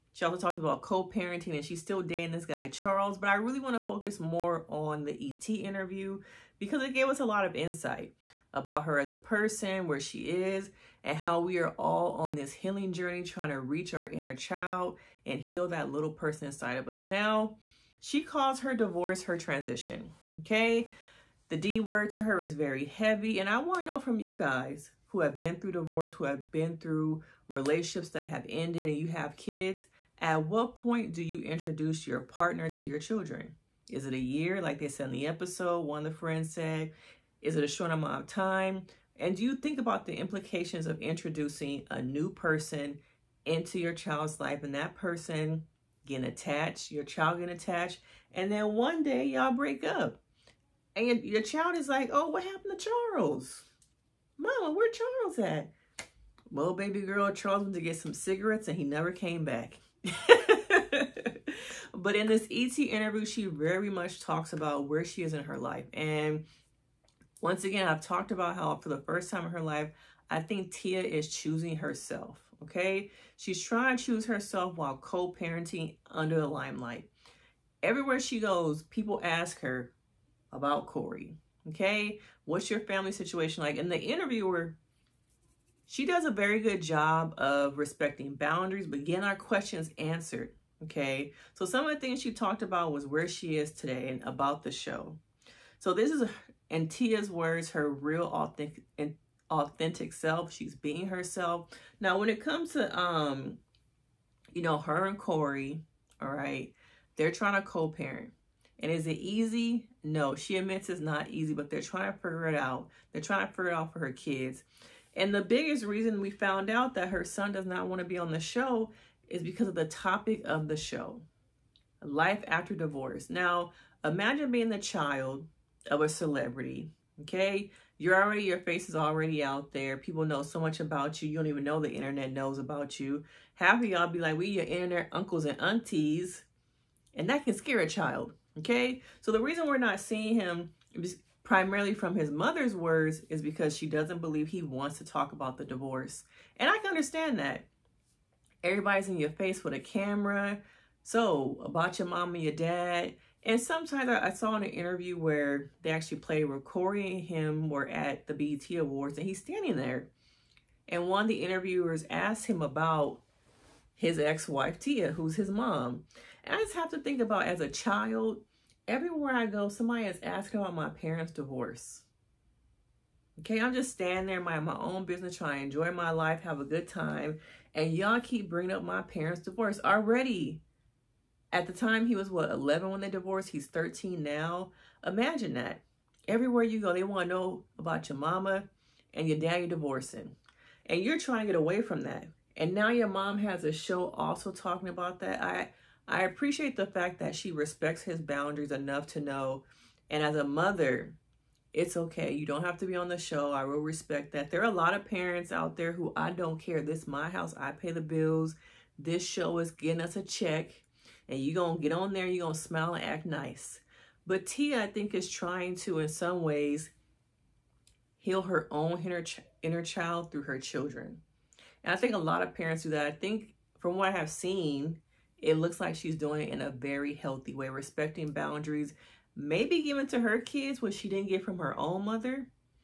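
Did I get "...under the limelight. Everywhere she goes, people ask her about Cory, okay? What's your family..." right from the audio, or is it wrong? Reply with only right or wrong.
right.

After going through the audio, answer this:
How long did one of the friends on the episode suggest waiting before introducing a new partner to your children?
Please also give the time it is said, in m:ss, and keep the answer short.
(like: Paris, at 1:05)
a year, at 0:34.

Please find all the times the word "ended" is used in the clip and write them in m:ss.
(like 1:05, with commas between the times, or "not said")
0:28.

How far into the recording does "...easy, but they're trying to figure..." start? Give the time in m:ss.
1:51.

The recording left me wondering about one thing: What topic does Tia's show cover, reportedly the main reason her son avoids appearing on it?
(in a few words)
life after divorce.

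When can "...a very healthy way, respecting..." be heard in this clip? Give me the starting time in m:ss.
3:46.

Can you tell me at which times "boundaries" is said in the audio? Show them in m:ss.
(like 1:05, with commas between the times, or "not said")
1:28, 3:18, 3:48.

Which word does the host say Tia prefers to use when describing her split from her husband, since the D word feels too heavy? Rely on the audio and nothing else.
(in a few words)
transition.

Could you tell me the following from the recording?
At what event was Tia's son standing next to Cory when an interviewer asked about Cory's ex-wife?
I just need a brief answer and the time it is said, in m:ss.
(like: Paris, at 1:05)
BET Awards, at 2:38.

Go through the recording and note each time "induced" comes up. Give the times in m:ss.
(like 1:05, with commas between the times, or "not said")
not said.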